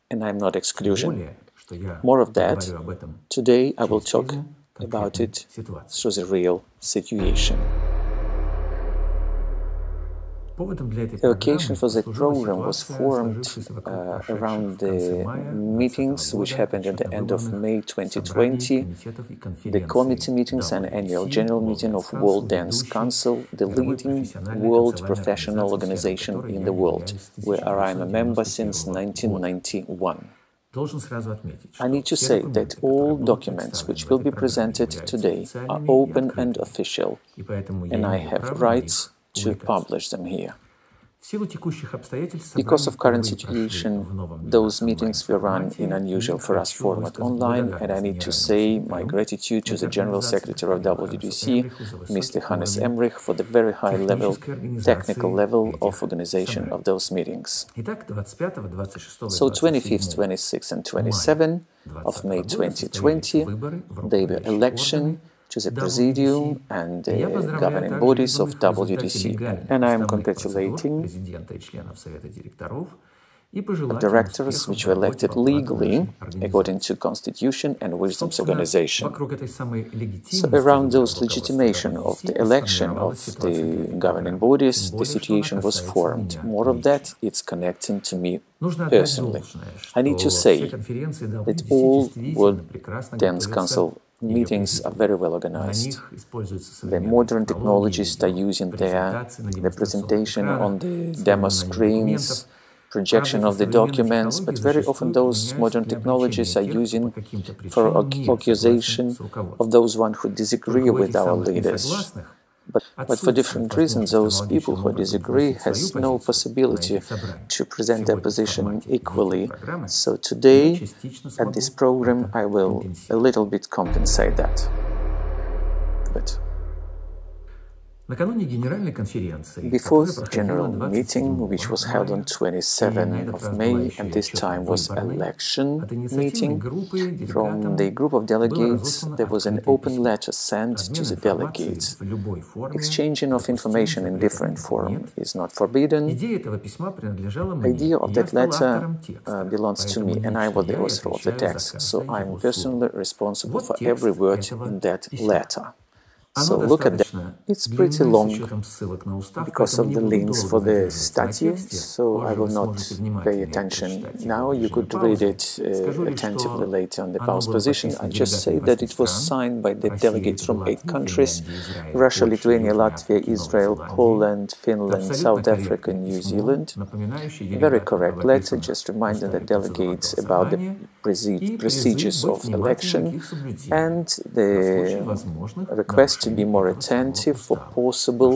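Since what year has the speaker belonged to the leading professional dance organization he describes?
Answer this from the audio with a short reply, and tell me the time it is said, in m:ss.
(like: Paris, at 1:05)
1991, at 0:28.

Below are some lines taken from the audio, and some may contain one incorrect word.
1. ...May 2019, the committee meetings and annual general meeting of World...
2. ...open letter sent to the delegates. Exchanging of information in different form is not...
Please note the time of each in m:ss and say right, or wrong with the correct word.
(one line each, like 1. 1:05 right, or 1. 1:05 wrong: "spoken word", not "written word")
1. 0:17 wrong: "2020", not "2019"
2. 2:19 right.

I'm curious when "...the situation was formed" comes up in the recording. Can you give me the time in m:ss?
1:24.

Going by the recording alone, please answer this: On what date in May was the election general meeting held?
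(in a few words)
27 May.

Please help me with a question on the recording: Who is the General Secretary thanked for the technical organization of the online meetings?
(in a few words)
Hannes Emrich.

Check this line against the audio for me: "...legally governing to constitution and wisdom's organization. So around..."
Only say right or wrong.
wrong.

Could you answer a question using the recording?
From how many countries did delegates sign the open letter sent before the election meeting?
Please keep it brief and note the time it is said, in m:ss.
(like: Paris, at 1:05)
8, at 2:50.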